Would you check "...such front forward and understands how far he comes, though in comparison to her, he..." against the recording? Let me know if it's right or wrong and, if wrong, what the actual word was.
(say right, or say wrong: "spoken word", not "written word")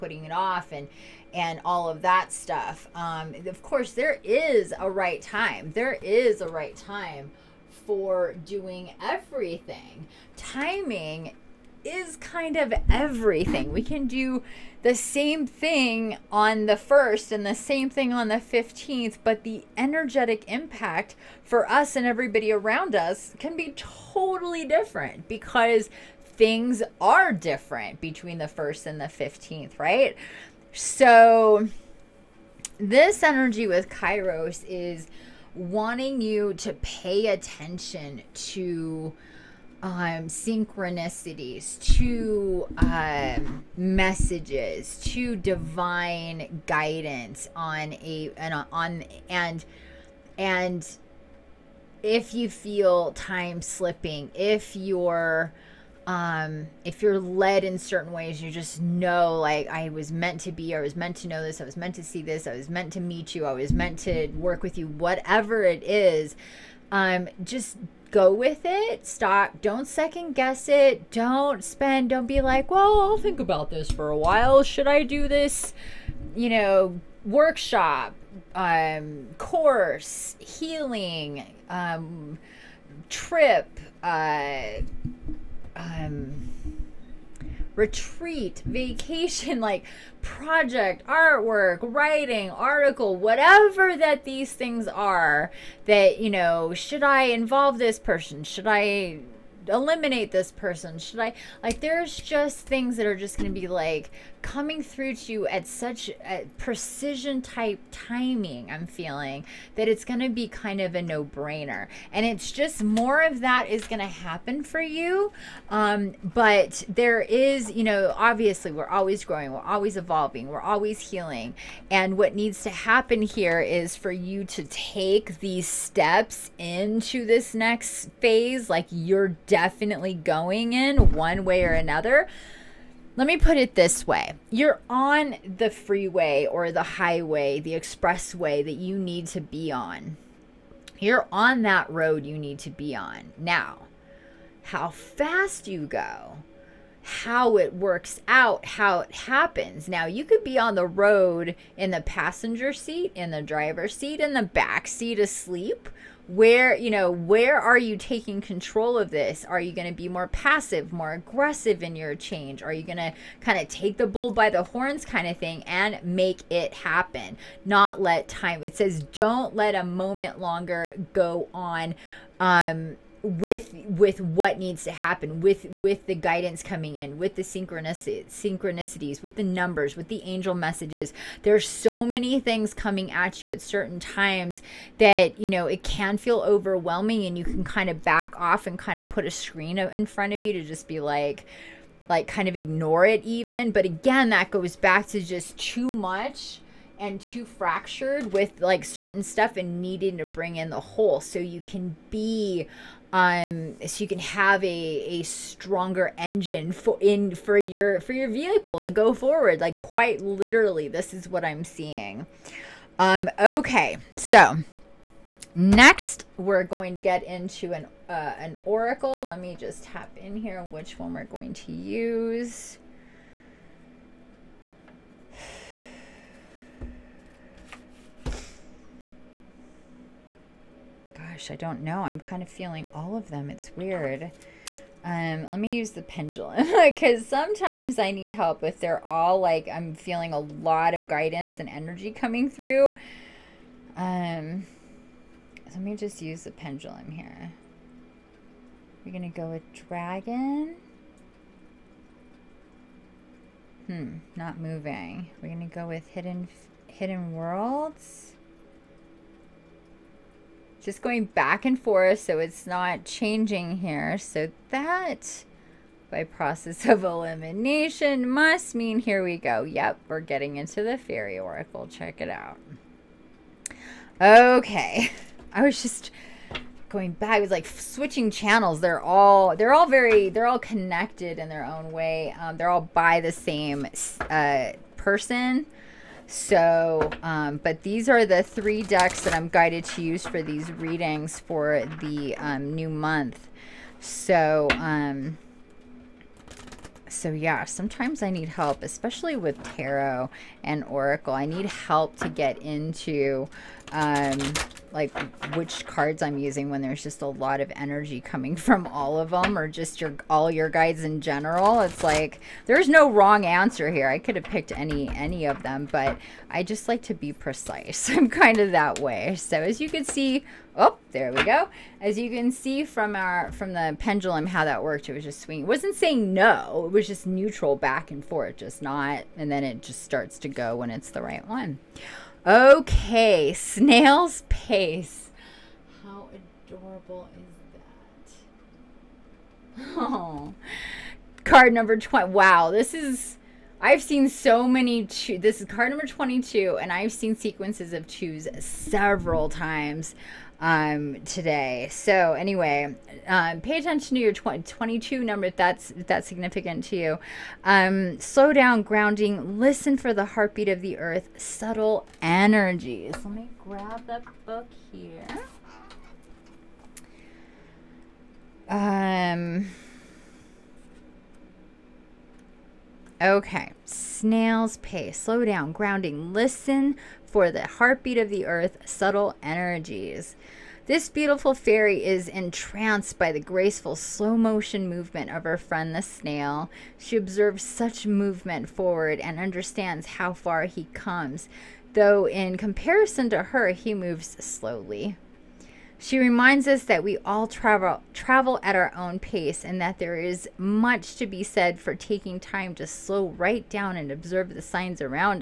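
wrong: "movement", not "front".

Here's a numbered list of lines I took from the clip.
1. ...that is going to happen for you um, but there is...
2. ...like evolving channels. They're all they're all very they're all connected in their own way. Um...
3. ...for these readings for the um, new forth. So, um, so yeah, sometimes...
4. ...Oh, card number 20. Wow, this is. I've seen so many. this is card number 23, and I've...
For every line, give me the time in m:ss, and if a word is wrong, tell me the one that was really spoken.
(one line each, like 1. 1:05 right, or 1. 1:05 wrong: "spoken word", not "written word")
1. 1:53 right
2. 4:37 wrong: "switching", not "evolving"
3. 4:50 wrong: "month", not "forth"
4. 5:39 wrong: "22", not "23".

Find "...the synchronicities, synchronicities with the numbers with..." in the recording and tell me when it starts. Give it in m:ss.
2:57.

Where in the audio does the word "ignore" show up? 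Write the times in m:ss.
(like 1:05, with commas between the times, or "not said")
3:12.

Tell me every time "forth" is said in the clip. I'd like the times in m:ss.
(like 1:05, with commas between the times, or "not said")
4:21, 5:28.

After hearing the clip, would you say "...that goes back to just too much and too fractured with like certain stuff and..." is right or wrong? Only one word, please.
right.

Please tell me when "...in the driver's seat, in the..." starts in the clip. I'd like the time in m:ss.
2:33.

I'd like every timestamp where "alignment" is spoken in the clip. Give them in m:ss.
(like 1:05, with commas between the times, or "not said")
not said.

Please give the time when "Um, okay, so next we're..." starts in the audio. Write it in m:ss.
3:32.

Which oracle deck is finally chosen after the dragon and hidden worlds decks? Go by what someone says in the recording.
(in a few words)
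fairy oracle.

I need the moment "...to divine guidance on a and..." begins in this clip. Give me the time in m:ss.
0:45.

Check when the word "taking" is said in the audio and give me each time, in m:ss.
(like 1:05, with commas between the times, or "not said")
2:37, 6:41.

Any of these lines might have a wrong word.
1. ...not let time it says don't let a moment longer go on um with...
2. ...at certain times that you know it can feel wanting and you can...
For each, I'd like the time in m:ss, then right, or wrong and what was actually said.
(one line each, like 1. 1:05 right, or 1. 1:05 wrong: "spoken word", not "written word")
1. 2:47 right
2. 3:03 wrong: "overwhelming", not "wanting".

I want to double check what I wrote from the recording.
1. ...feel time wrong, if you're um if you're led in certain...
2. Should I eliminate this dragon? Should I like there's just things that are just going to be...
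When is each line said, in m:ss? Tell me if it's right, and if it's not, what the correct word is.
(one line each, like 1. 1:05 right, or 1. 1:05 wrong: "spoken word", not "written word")
1. 0:52 wrong: "slipping", not "wrong"
2. 1:38 wrong: "person", not "dragon".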